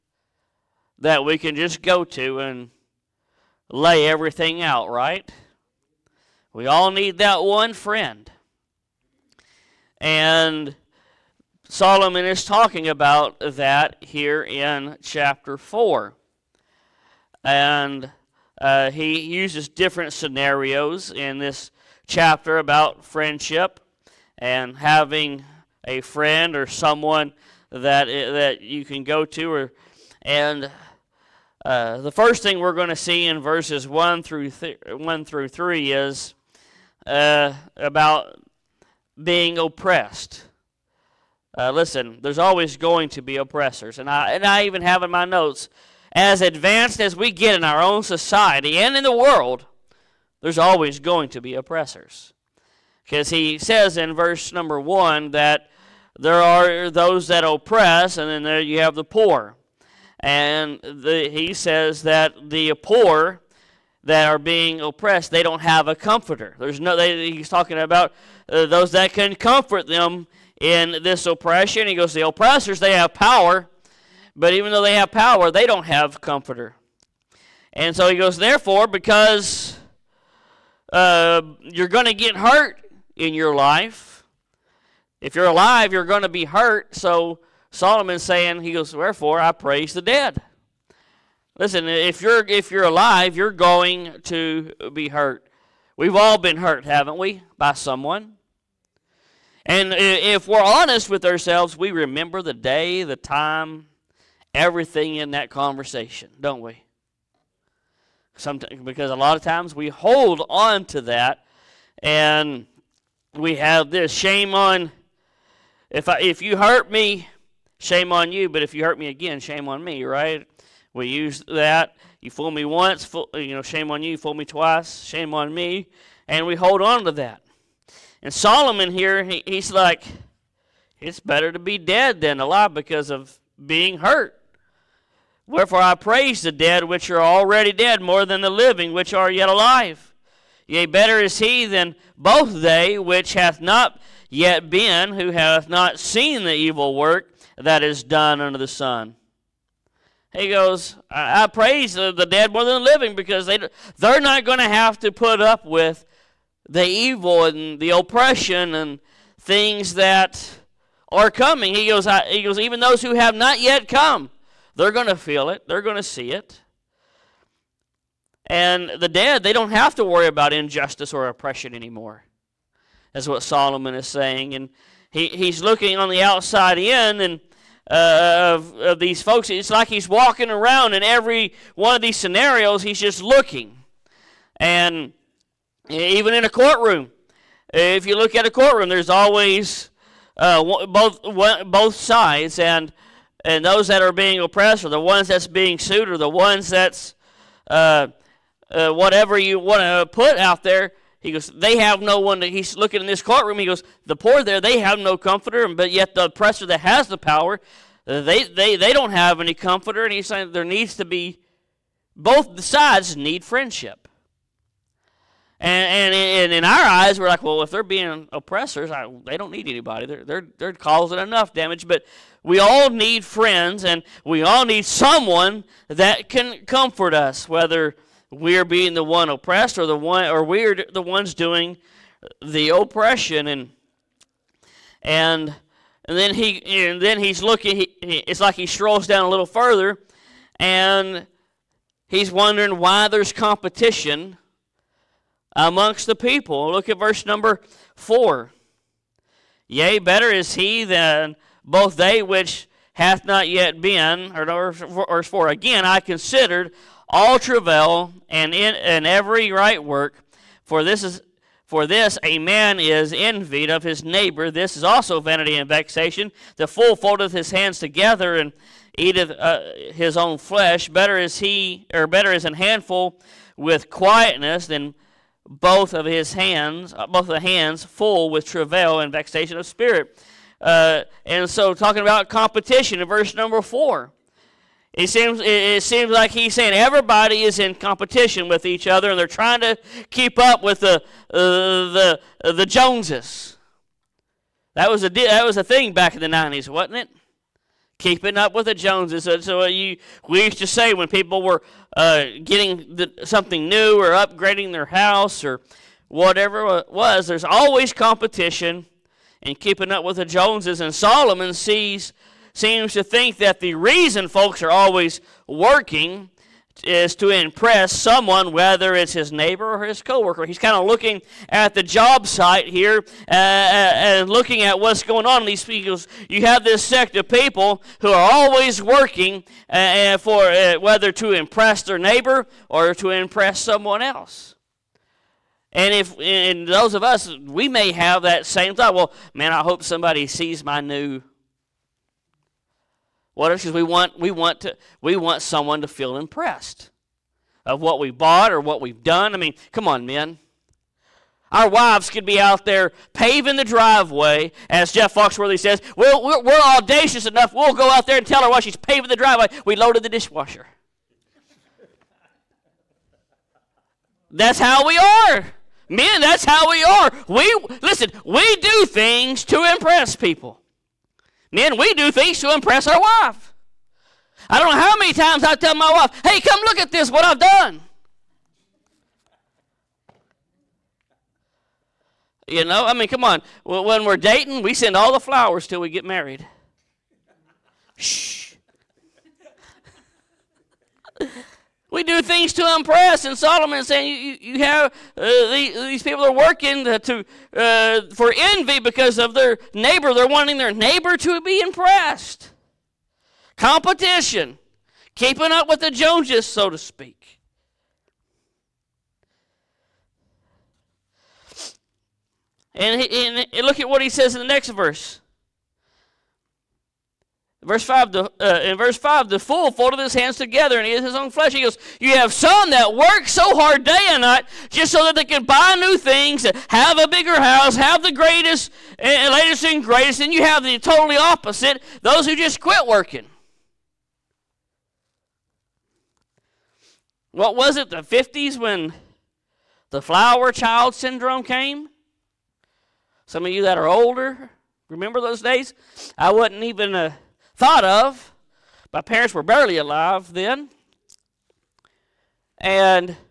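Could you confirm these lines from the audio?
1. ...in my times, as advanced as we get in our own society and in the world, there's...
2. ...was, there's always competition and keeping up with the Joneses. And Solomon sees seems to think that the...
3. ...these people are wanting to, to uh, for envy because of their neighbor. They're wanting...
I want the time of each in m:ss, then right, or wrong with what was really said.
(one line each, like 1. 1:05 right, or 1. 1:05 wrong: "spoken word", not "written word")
1. 0:45 wrong: "notes", not "times"
2. 5:06 right
3. 6:35 wrong: "working", not "wanting".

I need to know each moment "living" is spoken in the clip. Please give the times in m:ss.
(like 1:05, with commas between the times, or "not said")
2:18, 2:32.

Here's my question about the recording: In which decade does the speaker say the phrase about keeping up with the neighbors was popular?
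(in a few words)
The 90s.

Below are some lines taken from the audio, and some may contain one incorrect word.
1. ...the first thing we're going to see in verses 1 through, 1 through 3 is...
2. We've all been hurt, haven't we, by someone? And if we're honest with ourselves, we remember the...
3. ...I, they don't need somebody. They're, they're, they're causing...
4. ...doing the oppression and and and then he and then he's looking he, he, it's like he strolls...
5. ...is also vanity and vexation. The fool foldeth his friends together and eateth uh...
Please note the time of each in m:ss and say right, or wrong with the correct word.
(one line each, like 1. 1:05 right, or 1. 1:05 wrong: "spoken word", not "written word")
1. 0:31 right
2. 1:35 right
3. 3:38 wrong: "anybody", not "somebody"
4. 3:51 right
5. 4:24 wrong: "hands", not "friends".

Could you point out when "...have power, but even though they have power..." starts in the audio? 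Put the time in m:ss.
1:12.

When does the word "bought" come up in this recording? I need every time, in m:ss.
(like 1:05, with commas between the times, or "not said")
5:48.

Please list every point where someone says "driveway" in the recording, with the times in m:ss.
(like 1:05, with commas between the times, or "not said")
5:53, 5:59.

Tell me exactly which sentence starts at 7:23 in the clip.
Some of you that are older, remember those days?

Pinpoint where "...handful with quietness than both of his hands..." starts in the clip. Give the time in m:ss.
4:32.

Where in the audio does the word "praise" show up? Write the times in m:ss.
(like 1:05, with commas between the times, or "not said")
1:29, 2:15, 2:31.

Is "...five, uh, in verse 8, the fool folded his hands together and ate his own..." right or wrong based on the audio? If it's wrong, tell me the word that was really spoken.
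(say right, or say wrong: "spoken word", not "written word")
wrong: "5", not "8".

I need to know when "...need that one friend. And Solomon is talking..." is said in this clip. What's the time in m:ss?
0:06.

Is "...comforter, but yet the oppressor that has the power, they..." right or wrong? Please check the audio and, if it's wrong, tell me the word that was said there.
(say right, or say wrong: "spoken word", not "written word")
right.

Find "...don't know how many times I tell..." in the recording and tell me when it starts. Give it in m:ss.
6:14.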